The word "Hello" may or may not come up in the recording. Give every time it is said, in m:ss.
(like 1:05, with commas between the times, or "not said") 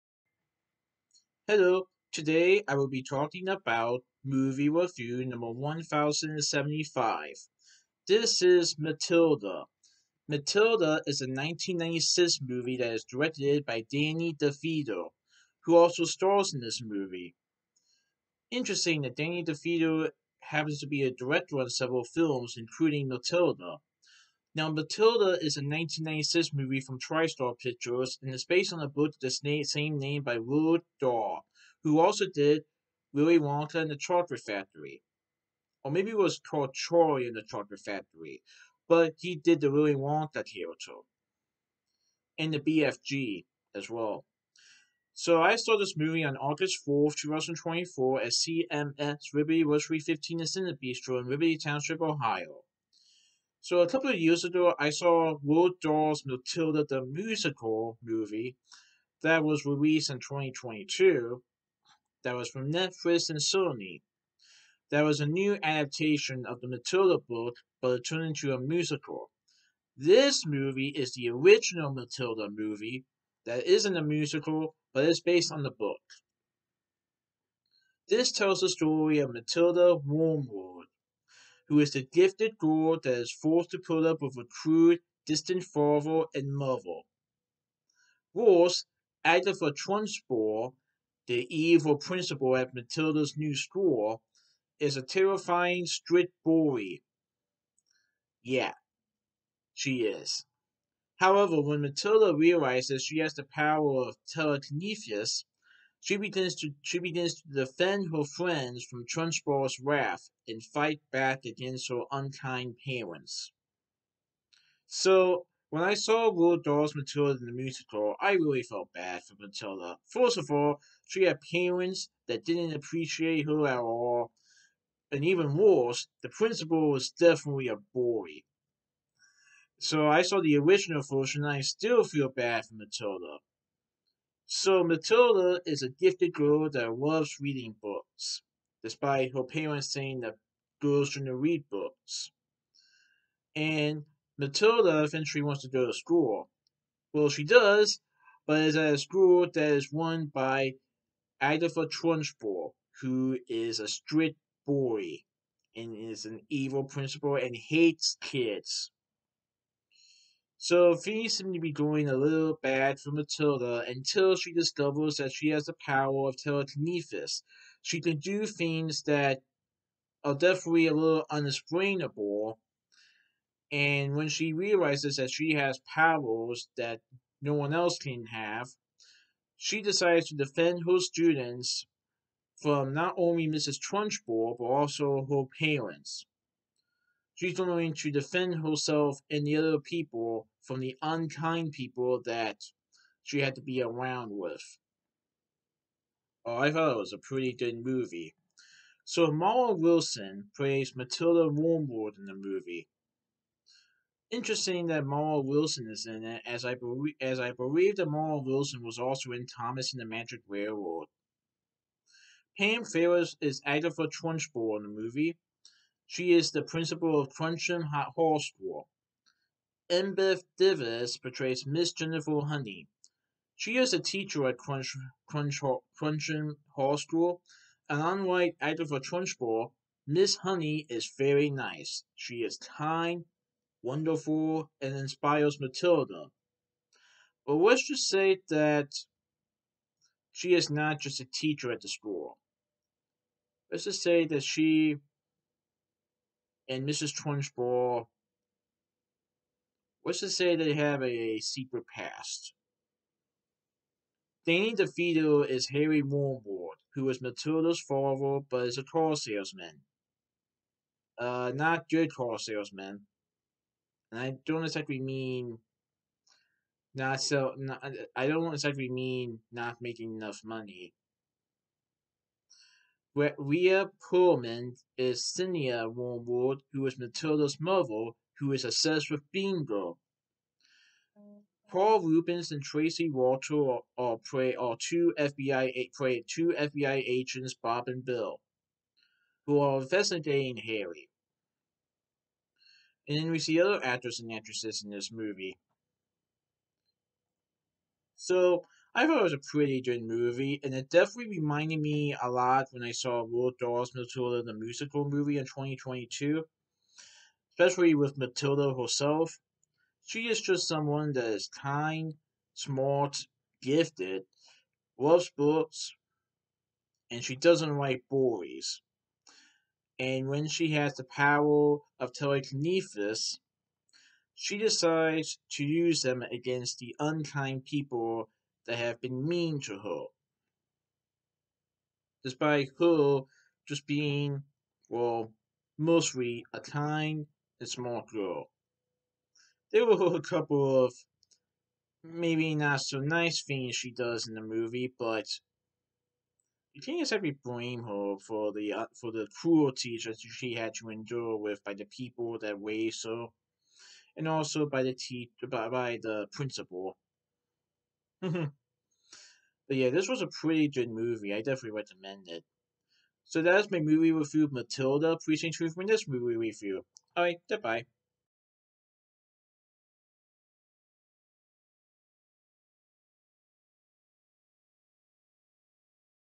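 0:01.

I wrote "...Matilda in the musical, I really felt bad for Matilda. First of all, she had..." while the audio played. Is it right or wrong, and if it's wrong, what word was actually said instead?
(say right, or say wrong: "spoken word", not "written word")
right.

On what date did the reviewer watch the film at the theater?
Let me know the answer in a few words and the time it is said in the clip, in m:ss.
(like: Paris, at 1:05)
August 4th, 2024, at 0:46.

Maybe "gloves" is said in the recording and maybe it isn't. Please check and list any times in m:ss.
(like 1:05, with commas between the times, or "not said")
not said.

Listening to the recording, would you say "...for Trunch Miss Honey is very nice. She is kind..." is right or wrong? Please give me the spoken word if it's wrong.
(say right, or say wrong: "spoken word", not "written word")
right.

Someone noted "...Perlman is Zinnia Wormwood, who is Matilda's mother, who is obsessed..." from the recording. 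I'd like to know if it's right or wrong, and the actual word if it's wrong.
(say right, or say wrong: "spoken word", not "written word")
right.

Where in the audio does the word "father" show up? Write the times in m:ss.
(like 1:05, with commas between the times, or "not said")
1:25, 4:17.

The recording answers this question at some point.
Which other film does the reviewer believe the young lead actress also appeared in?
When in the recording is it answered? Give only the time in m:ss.
3:29.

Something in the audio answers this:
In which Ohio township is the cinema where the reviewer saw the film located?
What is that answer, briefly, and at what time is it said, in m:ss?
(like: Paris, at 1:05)
Liberty Township, at 0:51.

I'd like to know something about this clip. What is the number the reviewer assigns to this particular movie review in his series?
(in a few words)
1075.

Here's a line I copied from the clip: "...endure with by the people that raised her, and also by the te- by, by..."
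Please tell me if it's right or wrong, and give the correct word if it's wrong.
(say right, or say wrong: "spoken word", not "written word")
right.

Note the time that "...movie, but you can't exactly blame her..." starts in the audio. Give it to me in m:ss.
5:44.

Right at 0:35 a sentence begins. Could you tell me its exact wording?
Or maybe it was called Charlie and the Chocolate Factory, but he did the Willy Wonka character.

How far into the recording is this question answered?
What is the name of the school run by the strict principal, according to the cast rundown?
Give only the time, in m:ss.
3:37.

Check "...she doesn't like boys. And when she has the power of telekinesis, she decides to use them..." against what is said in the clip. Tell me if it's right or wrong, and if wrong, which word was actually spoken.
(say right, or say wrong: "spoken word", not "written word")
right.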